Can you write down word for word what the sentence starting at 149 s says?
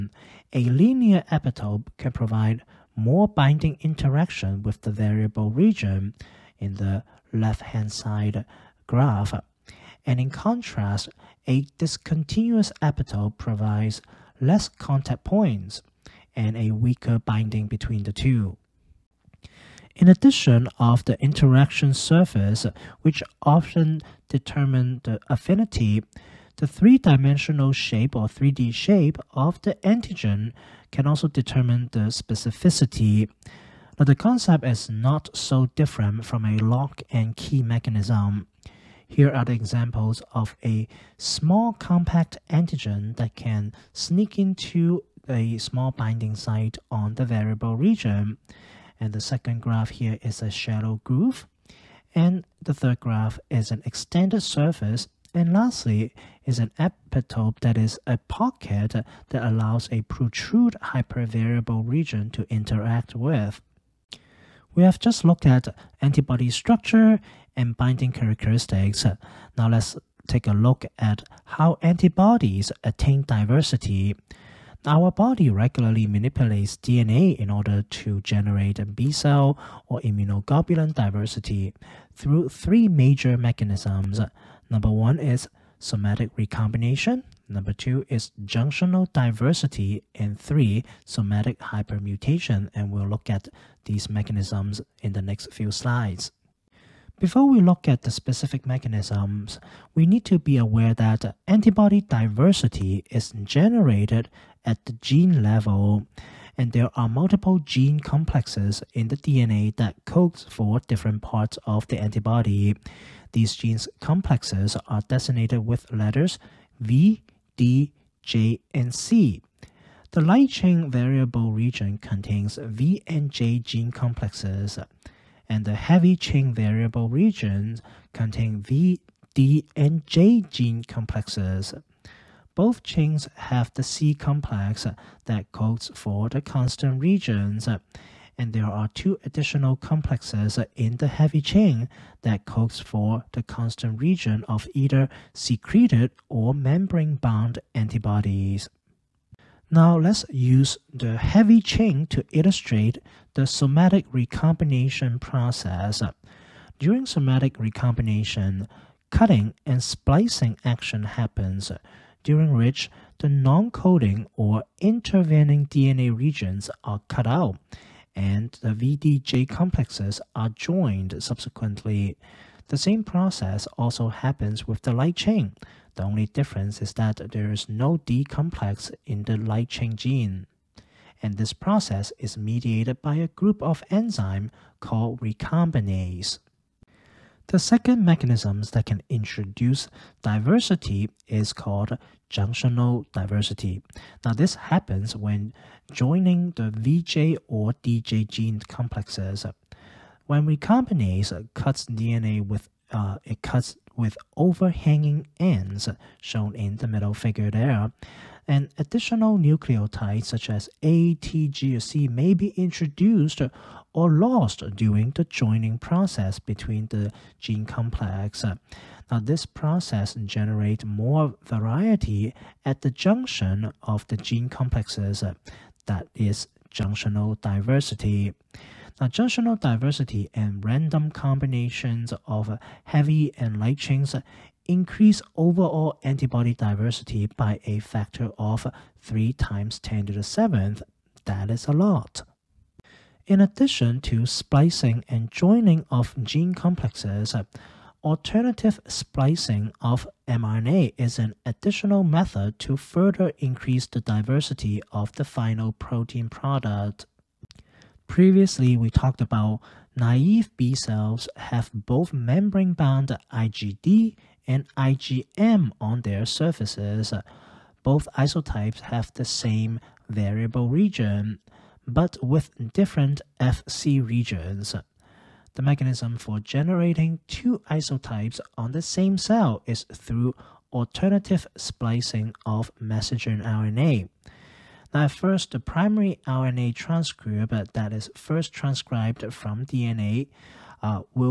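Now let's use the heavy chain to illustrate the somatic recombination process.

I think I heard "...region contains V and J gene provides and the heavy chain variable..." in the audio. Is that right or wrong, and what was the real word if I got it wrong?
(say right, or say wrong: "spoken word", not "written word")
wrong: "complexes", not "provides".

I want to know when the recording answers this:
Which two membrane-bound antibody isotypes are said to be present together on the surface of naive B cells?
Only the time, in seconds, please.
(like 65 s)
263 s.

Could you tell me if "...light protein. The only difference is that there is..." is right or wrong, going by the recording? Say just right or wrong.
wrong.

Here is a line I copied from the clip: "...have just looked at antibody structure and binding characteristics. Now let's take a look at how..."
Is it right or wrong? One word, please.
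right.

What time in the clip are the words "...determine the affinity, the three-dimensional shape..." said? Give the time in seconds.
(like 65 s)
24 s.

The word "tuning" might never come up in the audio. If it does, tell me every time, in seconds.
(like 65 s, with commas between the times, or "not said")
not said.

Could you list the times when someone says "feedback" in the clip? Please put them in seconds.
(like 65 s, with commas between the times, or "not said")
not said.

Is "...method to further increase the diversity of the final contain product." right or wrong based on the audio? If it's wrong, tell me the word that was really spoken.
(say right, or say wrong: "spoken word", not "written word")
wrong: "protein", not "contain".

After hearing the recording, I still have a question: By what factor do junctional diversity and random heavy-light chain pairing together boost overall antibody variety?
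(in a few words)
3 x 10^7.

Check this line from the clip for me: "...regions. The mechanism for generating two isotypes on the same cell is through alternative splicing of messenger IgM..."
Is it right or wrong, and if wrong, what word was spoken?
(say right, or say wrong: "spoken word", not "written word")
wrong: "RNA", not "IgM".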